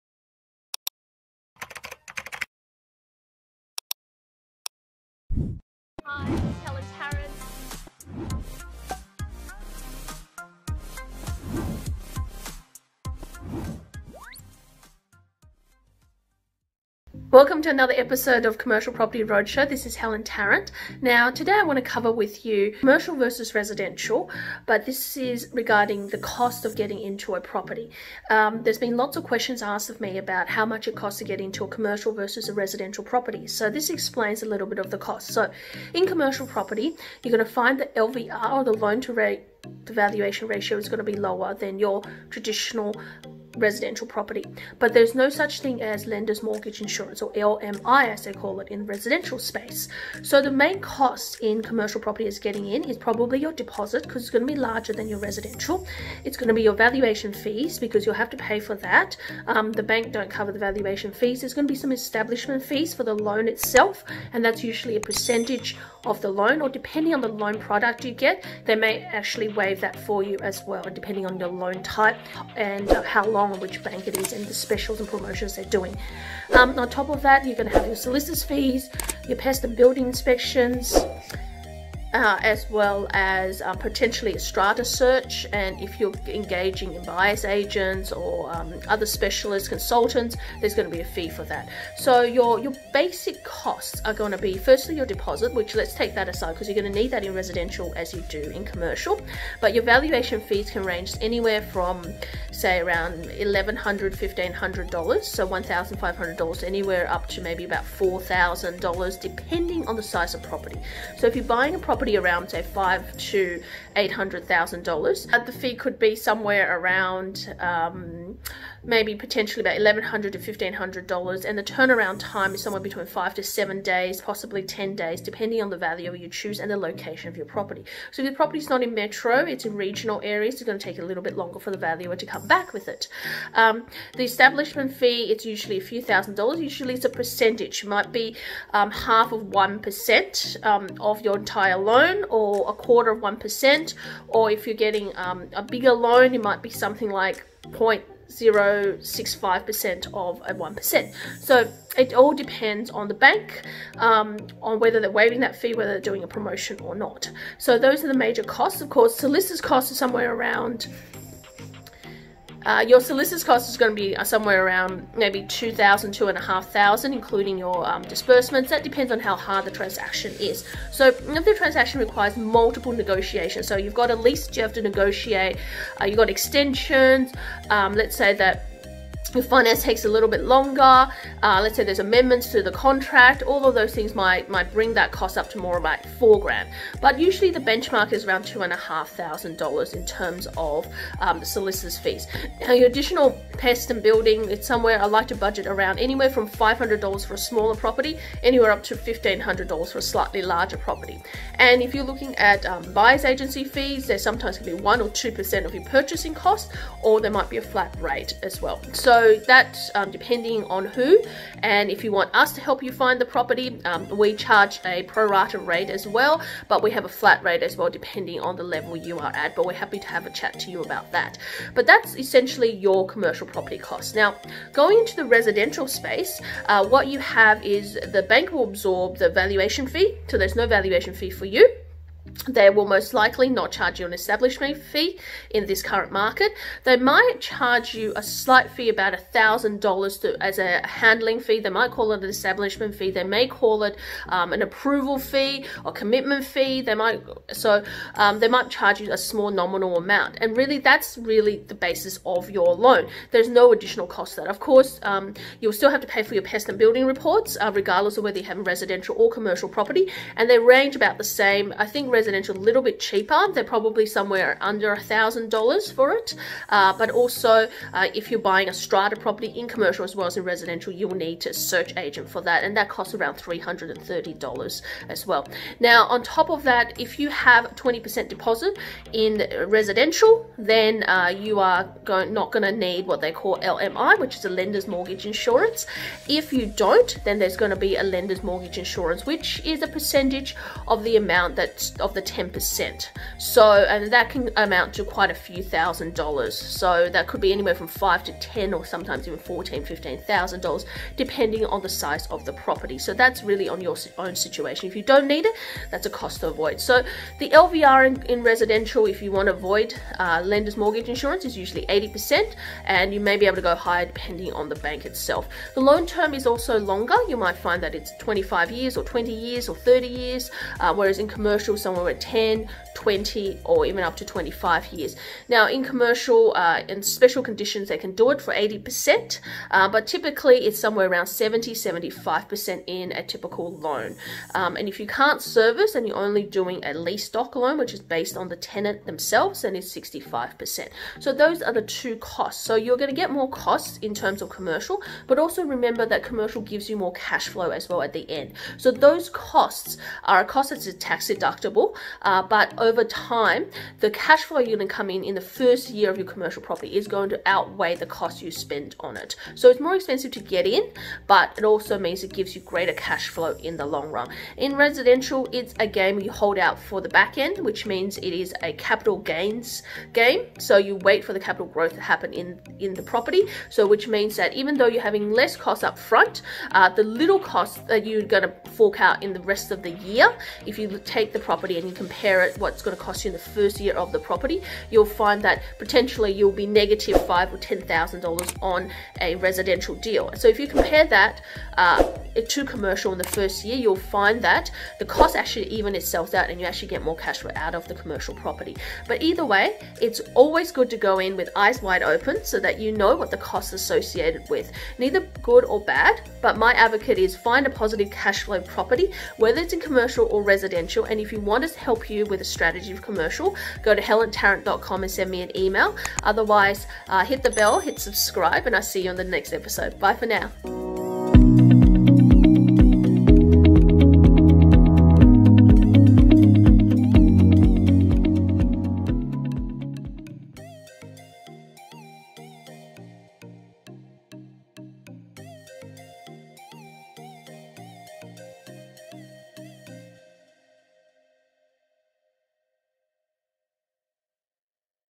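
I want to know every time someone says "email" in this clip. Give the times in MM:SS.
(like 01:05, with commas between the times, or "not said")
06:55.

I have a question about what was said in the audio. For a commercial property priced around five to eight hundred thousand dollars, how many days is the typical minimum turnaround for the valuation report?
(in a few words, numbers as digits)
5 to 7 days.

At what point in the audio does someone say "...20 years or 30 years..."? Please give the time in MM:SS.
05:19.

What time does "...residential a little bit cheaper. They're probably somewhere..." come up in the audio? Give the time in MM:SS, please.
04:22.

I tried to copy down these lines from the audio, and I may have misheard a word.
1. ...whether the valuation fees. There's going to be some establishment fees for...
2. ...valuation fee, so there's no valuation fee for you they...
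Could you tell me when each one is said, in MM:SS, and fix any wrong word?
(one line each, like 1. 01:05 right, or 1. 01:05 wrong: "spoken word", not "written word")
1. 01:00 wrong: "cover", not "whether"
2. 03:49 right.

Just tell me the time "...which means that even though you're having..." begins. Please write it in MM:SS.
06:13.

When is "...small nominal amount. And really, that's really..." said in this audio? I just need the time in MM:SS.
04:09.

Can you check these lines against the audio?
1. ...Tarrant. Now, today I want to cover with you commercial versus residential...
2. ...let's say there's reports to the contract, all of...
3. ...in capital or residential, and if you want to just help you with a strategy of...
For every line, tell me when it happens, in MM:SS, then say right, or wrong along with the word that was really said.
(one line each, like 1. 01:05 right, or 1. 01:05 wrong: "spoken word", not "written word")
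1. 00:20 right
2. 03:01 wrong: "amendments", not "reports"
3. 06:49 wrong: "commercial", not "capital".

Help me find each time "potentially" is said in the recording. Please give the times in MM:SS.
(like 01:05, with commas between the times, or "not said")
01:23, 01:59, 06:25.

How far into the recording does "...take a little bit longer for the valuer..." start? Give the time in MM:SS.
02:10.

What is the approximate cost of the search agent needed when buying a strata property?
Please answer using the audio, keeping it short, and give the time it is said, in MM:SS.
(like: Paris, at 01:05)
$330, at 04:33.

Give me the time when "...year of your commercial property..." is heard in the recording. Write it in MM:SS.
05:55.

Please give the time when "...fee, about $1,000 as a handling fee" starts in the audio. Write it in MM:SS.
03:58.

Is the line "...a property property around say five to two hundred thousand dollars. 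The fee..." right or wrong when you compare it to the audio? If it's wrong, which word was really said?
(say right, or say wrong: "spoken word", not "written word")
wrong: "eight", not "two".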